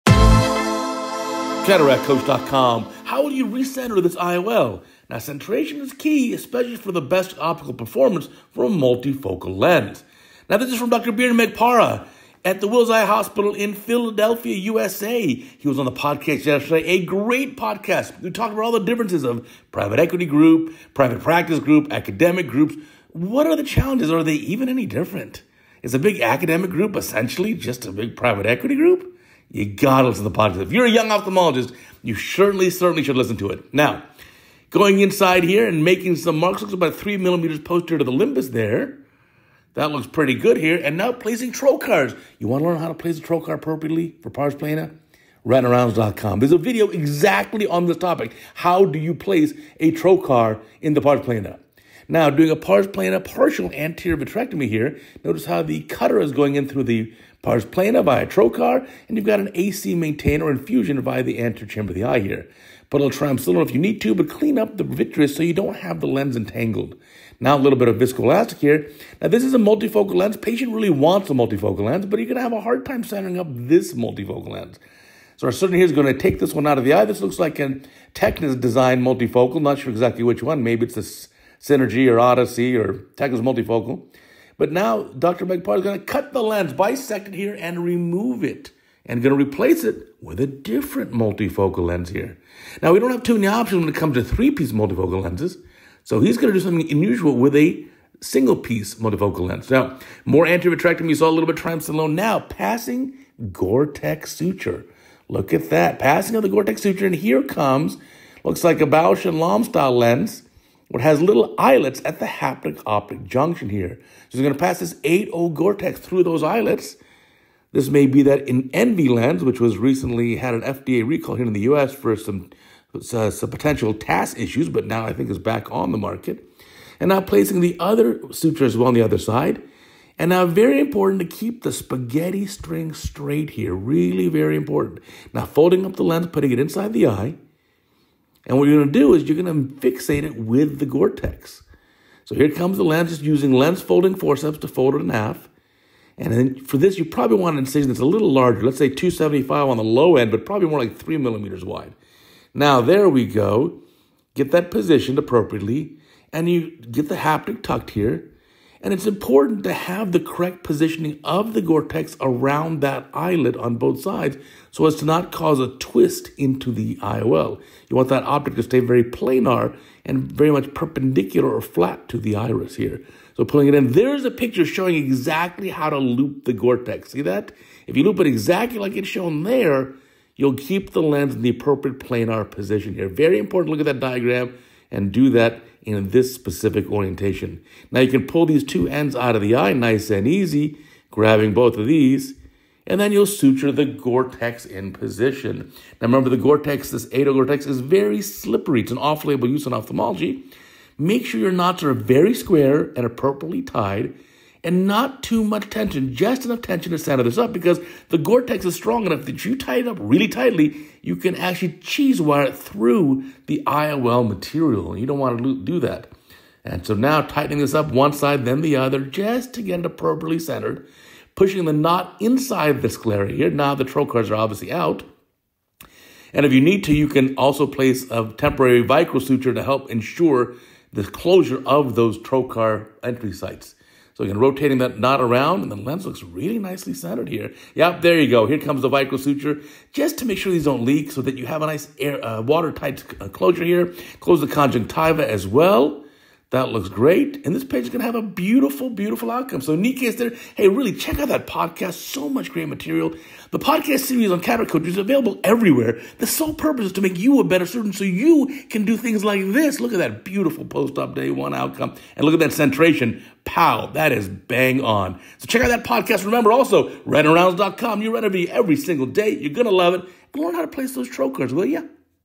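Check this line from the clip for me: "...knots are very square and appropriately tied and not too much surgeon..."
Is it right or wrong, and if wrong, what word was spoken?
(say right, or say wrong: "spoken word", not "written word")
wrong: "tension", not "surgeon".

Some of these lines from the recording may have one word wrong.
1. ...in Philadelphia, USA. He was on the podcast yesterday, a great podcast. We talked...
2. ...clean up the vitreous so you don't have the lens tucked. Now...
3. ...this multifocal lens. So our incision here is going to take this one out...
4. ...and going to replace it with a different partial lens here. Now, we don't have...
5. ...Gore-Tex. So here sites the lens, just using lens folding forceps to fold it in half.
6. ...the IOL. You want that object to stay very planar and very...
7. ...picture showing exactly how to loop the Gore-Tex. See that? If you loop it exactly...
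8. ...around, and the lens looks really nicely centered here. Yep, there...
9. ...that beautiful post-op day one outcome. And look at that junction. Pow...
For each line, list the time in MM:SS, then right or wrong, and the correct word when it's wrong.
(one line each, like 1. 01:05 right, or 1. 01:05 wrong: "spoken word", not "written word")
1. 00:13 right
2. 01:04 wrong: "entangled", not "tucked"
3. 01:13 wrong: "surgeon", not "incision"
4. 01:29 wrong: "multifocal", not "partial"
5. 02:20 wrong: "comes", not "sites"
6. 02:46 right
7. 02:54 right
8. 03:55 right
9. 04:19 wrong: "centration", not "junction".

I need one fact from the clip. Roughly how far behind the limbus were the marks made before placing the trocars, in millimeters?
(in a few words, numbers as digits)
3 millimeters.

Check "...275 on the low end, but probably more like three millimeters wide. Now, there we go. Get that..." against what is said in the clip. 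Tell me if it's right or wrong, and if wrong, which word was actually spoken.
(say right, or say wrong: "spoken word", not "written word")
right.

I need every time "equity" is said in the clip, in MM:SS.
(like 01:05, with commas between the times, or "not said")
00:19, 00:28.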